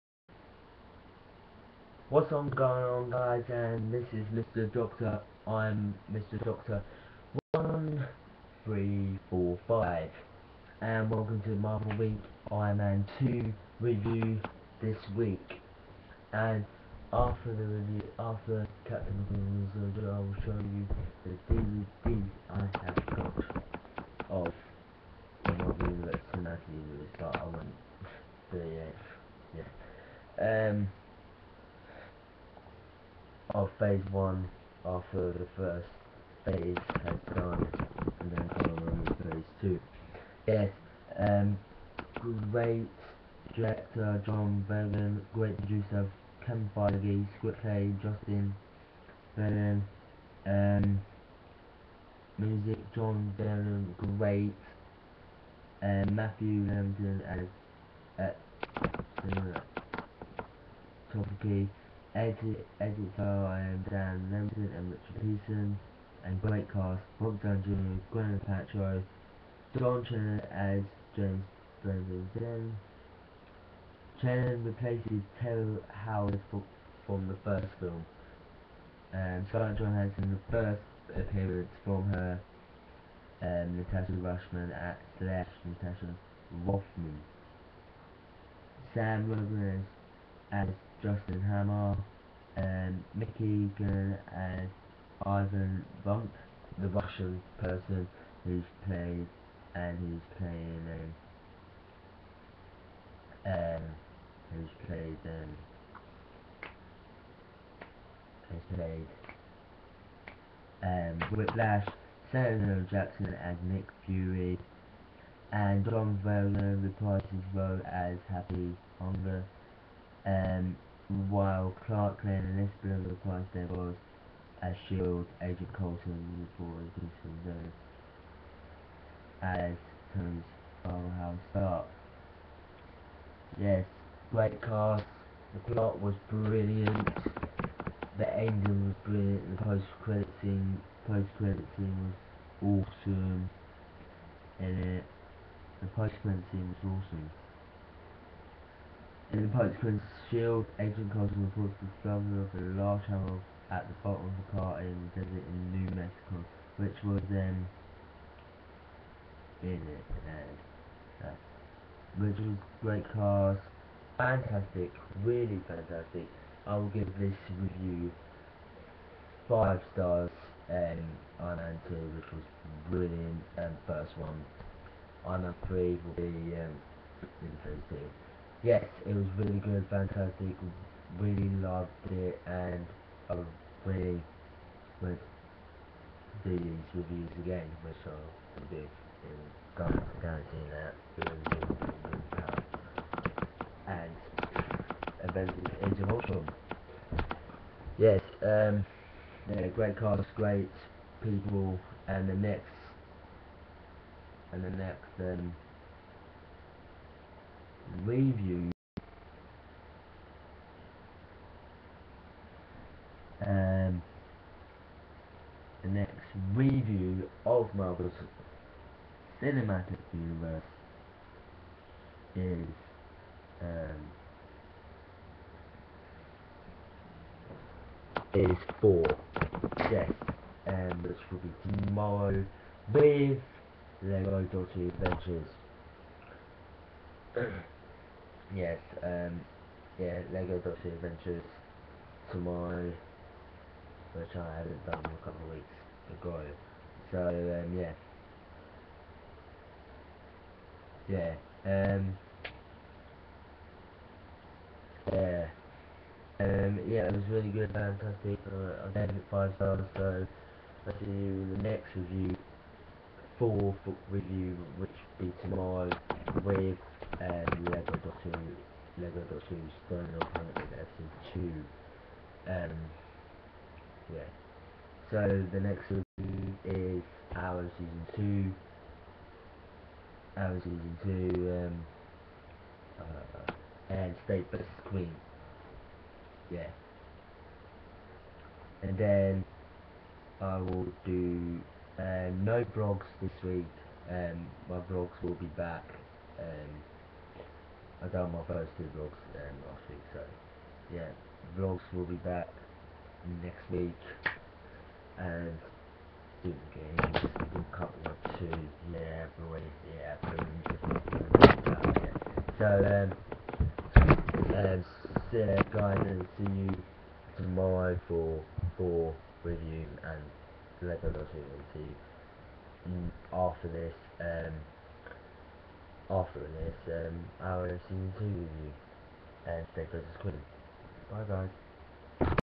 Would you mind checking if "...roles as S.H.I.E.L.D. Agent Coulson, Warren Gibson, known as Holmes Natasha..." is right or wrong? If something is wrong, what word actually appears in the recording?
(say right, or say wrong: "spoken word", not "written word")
wrong: "House", not "Natasha".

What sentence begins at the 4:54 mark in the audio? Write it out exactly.
Um, my vlogs will be back.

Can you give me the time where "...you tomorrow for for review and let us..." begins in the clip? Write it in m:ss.
5:16.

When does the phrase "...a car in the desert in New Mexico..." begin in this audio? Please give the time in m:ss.
2:34.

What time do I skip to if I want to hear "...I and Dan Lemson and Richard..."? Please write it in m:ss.
1:03.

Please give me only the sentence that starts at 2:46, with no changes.
I will give this review five stars um, on two, which was brilliant, and first one.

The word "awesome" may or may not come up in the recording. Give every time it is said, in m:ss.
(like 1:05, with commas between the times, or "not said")
2:23, 2:27.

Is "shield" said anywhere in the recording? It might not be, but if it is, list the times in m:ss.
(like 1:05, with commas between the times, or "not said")
2:04, 2:30.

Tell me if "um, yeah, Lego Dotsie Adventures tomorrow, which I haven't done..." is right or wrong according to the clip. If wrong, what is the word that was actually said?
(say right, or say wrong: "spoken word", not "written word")
right.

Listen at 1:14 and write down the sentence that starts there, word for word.
Chen replaces Terry Howard from the first film.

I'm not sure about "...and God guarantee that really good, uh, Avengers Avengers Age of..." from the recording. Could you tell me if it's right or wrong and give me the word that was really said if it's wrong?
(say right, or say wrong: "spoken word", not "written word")
wrong: "And", not "Avengers".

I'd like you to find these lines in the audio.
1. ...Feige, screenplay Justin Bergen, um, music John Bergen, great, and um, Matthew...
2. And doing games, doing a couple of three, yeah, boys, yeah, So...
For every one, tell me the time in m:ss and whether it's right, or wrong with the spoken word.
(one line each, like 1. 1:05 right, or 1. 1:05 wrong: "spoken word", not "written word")
1. 0:46 right
2. 5:05 wrong: "two", not "three".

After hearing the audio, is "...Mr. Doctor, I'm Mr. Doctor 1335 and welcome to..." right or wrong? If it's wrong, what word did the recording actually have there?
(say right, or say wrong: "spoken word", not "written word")
wrong: "1345", not "1335".